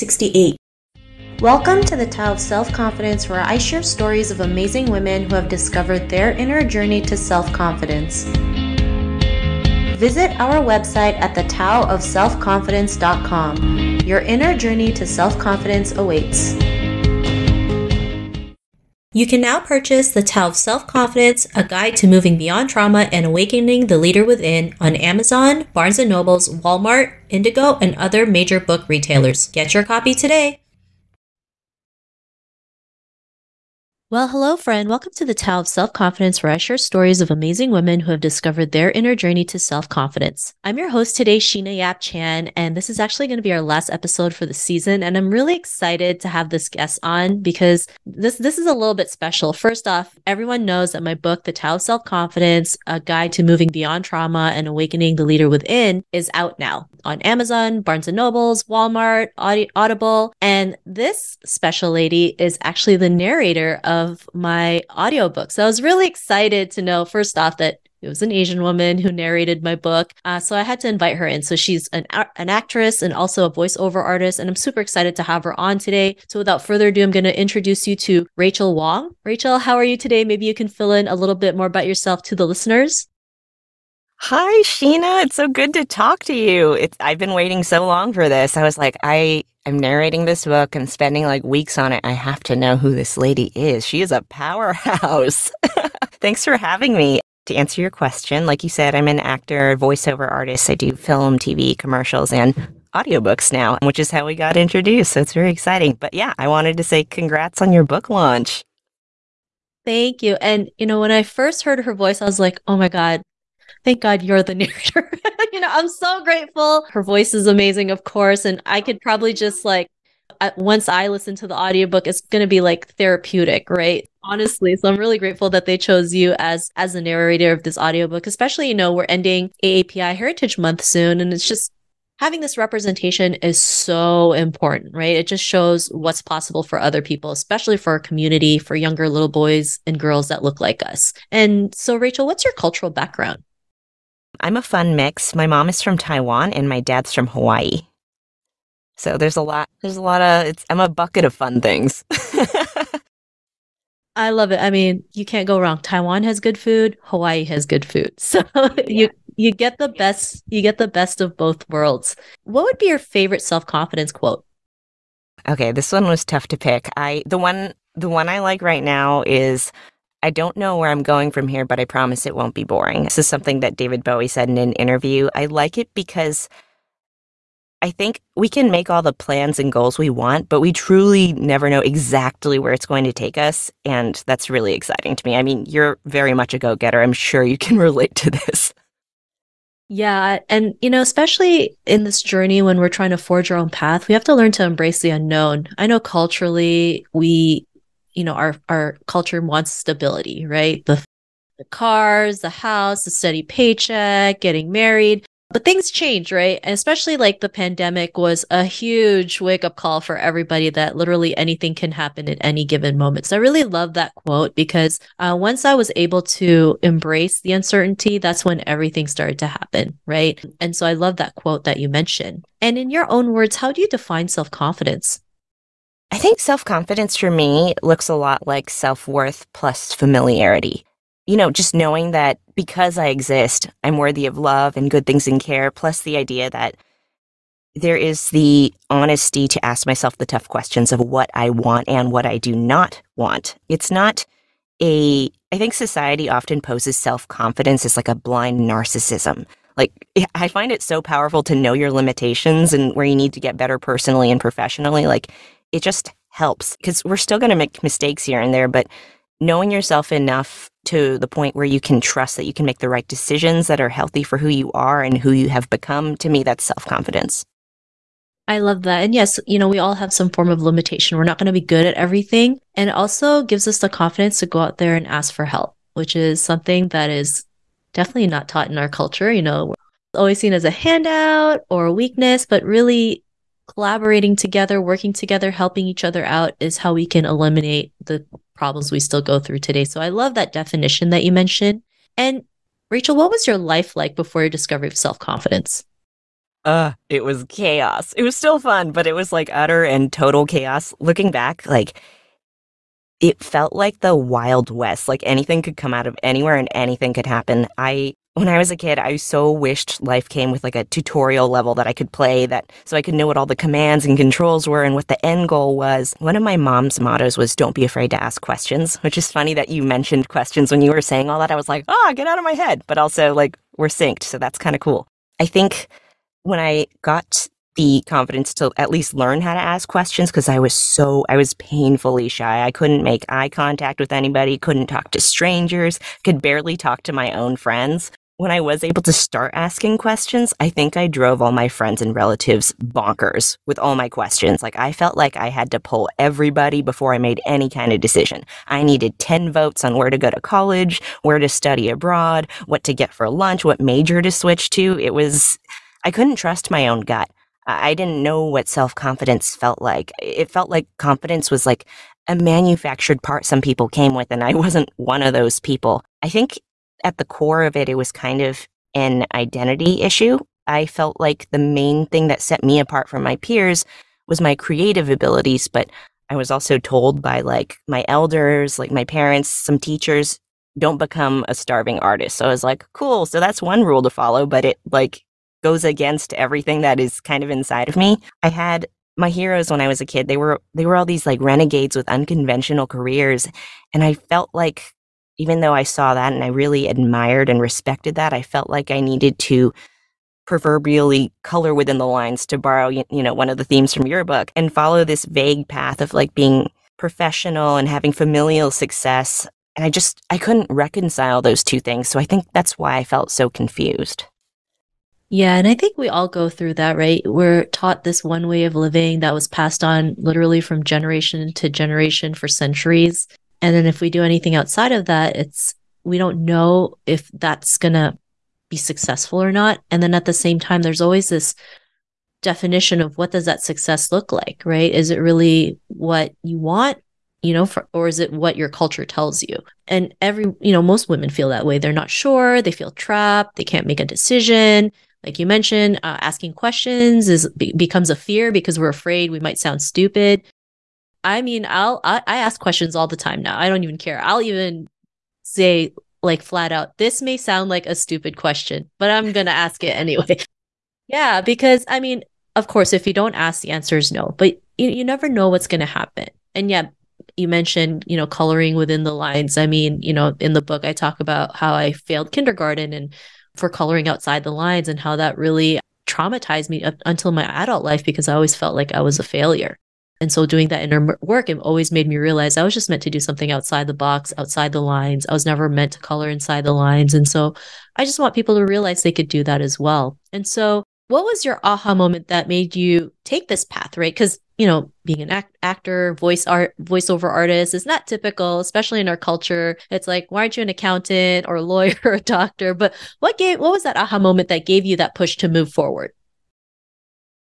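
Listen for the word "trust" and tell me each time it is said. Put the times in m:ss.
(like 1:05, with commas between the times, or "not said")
4:21, 5:56.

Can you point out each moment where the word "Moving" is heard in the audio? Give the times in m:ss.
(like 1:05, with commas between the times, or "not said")
0:22, 0:53.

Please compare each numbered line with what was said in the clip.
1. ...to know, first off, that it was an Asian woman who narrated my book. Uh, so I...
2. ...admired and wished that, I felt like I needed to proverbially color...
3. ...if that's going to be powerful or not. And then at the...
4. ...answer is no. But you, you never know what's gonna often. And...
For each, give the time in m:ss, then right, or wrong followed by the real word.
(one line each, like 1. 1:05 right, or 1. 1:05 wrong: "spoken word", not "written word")
1. 1:06 right
2. 6:36 wrong: "respected", not "wished"
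3. 7:07 wrong: "successful", not "powerful"
4. 7:43 wrong: "happen", not "often".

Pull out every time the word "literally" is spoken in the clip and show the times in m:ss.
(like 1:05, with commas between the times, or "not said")
3:30, 7:00.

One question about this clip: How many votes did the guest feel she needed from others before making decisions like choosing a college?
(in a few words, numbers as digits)
10.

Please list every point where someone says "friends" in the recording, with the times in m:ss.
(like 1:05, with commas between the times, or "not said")
0:34, 5:37, 5:41.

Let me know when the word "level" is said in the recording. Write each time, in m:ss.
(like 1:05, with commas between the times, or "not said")
5:11.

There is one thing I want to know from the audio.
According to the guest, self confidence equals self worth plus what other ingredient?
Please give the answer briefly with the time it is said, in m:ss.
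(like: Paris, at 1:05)
familiarity, at 3:49.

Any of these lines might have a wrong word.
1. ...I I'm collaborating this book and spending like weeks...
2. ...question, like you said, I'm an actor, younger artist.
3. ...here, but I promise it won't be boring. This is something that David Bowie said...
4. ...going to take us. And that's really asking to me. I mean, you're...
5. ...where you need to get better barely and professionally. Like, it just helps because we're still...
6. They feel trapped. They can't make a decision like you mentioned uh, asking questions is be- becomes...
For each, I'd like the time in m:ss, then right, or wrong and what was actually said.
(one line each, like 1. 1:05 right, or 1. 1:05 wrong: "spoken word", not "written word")
1. 1:29 wrong: "narrating", not "collaborating"
2. 1:37 wrong: "voiceover", not "younger"
3. 2:51 right
4. 3:02 wrong: "exciting", not "asking"
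5. 4:12 wrong: "personally", not "barely"
6. 7:22 right.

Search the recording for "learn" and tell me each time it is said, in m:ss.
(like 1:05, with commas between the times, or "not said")
3:14, 5:29.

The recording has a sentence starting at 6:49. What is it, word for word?
And I just, I couldn't reconcile those two things.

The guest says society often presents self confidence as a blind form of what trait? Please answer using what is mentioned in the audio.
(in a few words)
narcissism.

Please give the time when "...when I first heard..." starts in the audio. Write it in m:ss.
1:50.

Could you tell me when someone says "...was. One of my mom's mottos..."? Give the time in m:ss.
5:15.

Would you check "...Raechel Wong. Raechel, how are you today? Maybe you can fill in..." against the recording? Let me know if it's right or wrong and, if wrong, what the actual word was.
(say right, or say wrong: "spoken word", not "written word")
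right.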